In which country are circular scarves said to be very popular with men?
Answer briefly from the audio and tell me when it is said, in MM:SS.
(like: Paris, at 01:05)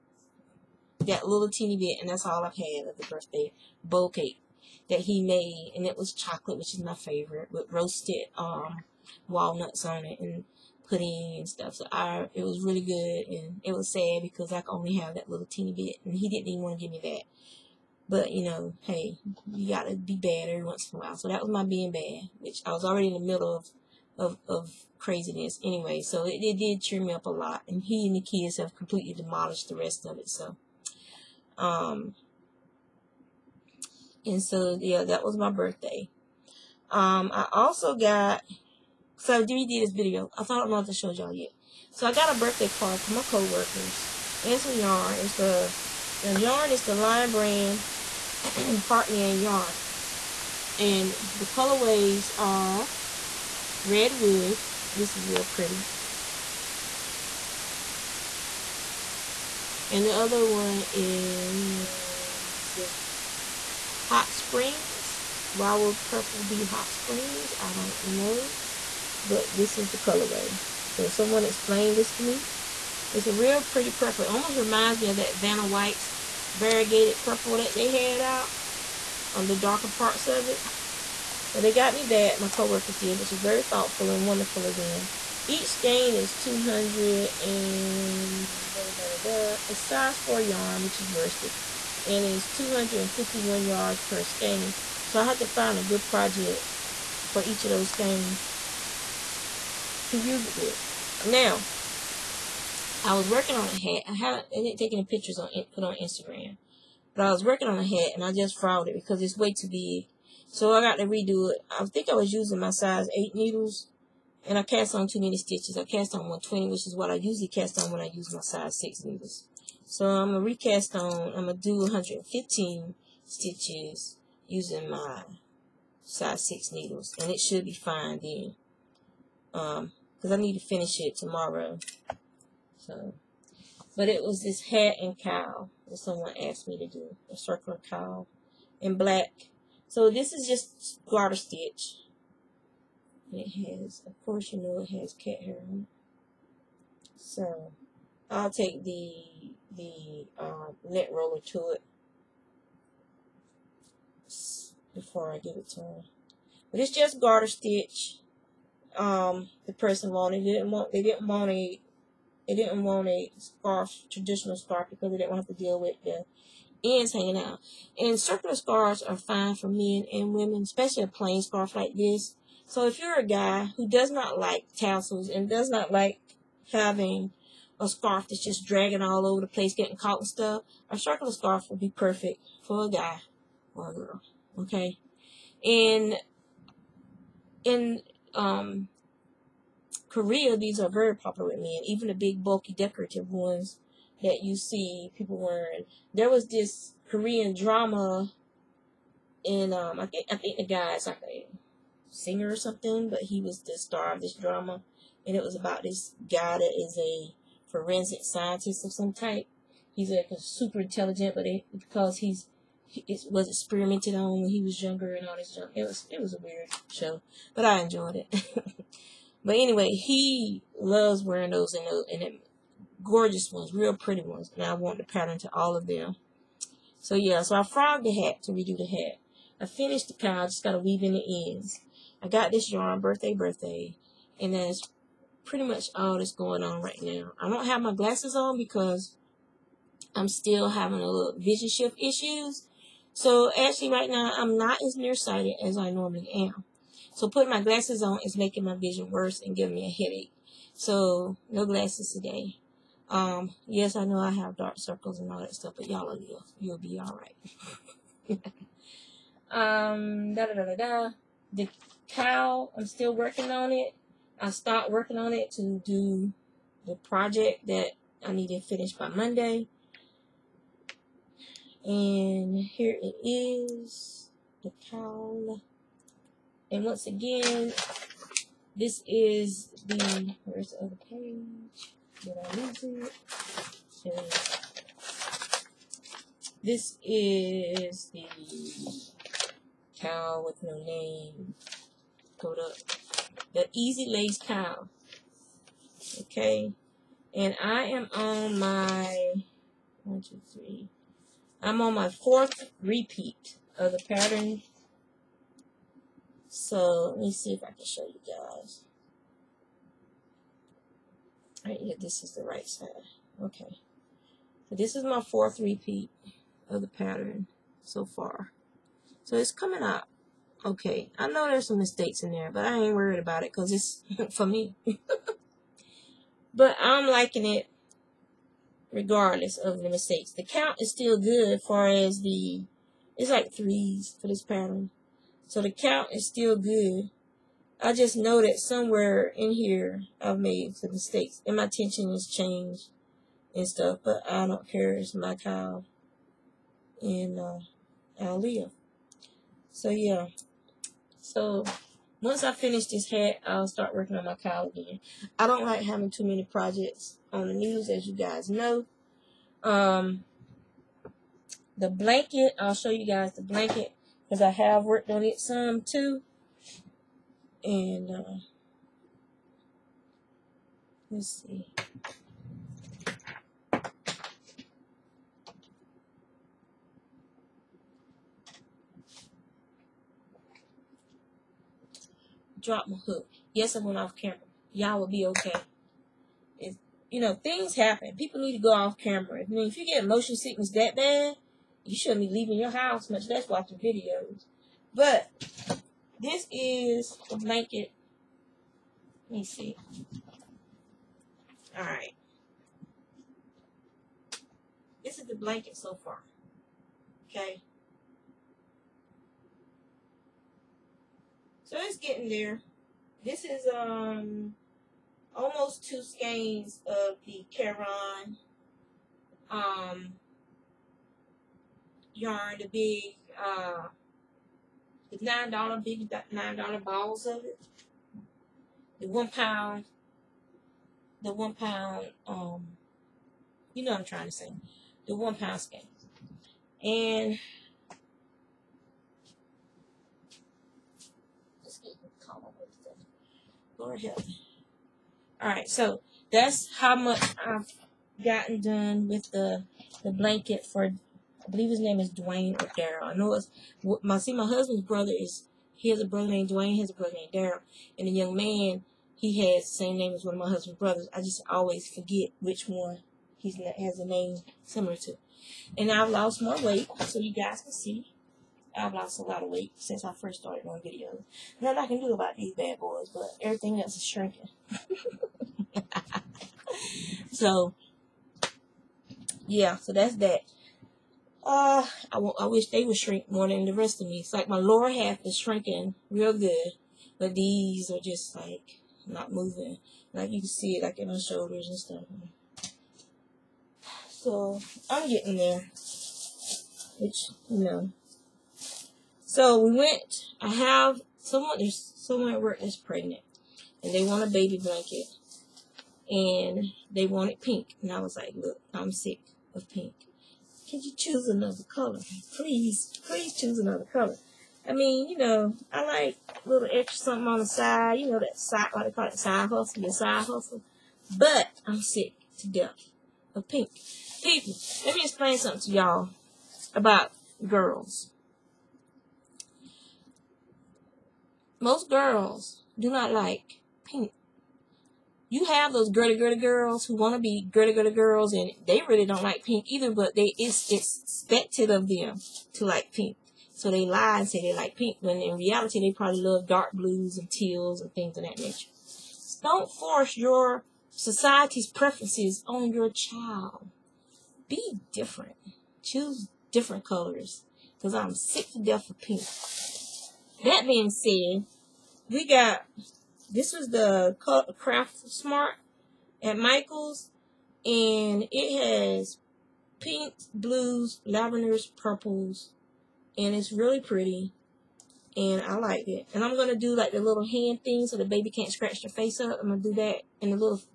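Korea, at 03:10.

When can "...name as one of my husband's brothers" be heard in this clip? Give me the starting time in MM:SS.
07:39.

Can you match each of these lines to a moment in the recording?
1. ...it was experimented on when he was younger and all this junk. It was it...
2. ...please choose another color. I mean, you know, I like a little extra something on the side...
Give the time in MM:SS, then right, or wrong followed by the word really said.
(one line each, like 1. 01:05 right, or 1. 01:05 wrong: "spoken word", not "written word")
1. 03:33 right
2. 08:33 right.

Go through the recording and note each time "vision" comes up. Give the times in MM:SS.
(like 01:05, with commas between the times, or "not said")
04:01, 04:08.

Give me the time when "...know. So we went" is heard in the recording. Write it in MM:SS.
08:17.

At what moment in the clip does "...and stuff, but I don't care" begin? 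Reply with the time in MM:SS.
05:43.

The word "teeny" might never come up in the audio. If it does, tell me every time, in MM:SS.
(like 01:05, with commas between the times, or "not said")
00:01, 00:15.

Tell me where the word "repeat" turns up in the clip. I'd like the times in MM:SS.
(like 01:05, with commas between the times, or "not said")
05:02, 05:15.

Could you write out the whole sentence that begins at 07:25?
All right, so that's how much I've gotten done with the the blanket for I believe his name is Dwayne or Daryl.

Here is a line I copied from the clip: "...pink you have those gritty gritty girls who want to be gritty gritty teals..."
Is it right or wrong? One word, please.
wrong.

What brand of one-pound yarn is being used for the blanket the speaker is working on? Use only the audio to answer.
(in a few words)
Caron.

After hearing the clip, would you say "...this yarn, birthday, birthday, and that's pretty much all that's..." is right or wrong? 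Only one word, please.
right.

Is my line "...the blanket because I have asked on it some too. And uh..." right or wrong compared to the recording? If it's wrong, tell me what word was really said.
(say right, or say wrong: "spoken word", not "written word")
wrong: "worked", not "asked".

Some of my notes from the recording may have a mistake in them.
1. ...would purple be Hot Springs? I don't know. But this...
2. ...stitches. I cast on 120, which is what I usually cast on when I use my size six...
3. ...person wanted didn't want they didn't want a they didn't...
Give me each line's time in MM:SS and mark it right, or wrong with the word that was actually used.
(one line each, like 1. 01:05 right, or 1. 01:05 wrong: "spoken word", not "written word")
1. 01:05 right
2. 01:55 right
3. 02:39 right.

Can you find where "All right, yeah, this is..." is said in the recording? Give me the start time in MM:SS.
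05:11.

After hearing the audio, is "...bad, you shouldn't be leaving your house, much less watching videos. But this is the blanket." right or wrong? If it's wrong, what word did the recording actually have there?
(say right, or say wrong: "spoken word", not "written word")
right.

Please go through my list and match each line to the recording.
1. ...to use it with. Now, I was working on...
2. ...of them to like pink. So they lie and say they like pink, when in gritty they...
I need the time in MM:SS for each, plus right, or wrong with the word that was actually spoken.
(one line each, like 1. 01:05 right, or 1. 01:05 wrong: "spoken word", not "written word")
1. 01:40 right
2. 09:01 wrong: "reality", not "gritty".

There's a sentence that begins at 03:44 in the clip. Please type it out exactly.
And I want the pattern to all of them.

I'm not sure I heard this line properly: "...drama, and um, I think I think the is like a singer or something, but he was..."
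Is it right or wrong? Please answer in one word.
right.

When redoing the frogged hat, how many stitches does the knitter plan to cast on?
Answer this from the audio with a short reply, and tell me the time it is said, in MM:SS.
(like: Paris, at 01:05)
115, at 02:01.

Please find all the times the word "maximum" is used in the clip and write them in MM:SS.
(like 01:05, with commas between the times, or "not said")
not said.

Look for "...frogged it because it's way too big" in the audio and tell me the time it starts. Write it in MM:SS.
01:48.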